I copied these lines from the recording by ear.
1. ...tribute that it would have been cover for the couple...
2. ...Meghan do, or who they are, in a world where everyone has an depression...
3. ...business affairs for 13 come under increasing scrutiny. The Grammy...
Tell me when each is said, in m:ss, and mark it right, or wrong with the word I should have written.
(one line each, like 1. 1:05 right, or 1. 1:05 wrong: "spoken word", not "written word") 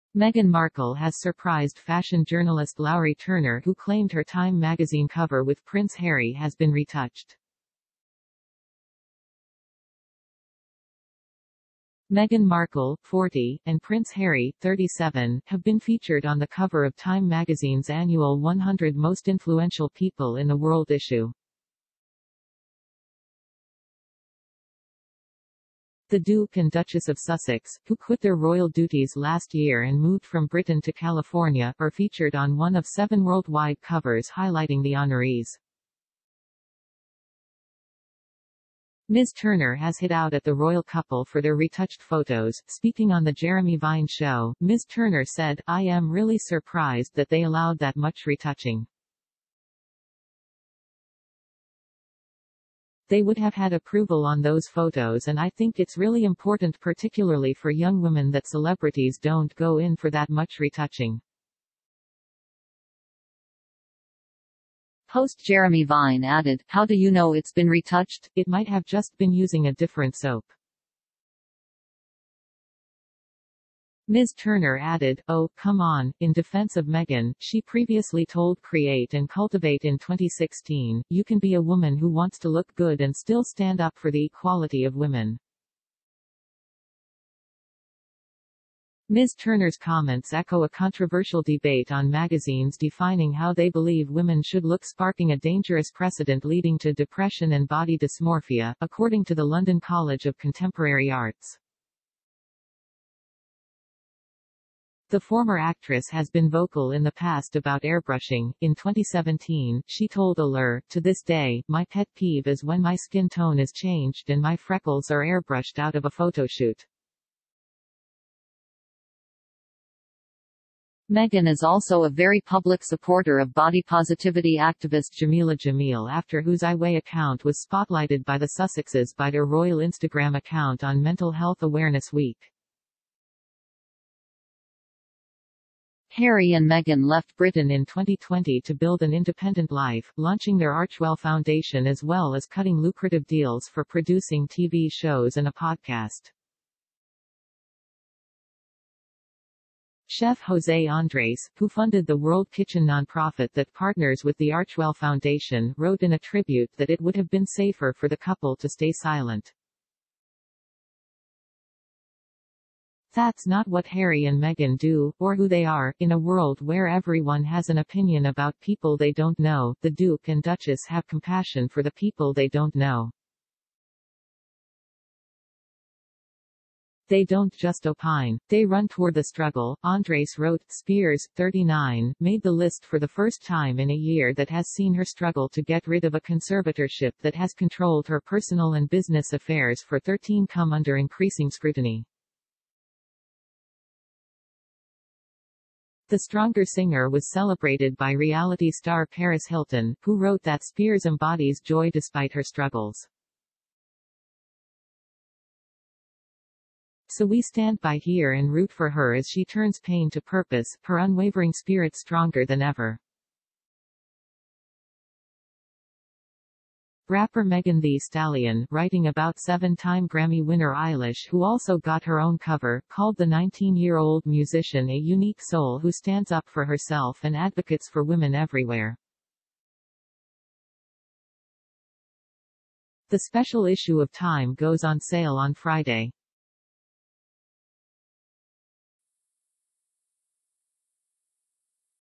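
1. 2:36 wrong: "safer", not "cover"
2. 2:44 wrong: "opinion", not "depression"
3. 3:08 wrong: "Stronger", not "Grammy".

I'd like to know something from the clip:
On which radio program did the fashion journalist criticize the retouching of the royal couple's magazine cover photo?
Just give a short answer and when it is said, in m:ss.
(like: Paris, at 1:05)
The Jeremy Vine Show, at 0:43.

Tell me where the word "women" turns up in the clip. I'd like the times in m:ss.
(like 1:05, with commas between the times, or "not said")
0:58, 1:24, 1:34, 3:48.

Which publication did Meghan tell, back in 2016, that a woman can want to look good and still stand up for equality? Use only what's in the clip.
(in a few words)
Create and Cultivate.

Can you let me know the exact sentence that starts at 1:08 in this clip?
It might have just been using a different soap.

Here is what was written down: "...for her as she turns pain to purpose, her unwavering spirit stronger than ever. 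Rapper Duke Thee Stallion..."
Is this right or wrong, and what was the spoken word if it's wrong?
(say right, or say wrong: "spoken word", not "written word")
wrong: "Megan", not "Duke".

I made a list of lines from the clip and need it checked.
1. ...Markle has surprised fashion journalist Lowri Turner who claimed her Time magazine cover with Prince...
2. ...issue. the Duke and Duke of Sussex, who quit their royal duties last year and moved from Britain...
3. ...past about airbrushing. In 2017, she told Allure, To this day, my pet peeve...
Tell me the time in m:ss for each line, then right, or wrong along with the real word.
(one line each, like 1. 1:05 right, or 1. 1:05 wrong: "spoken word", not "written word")
1. 0:00 right
2. 0:20 wrong: "Duchess", not "Duke"
3. 1:47 right.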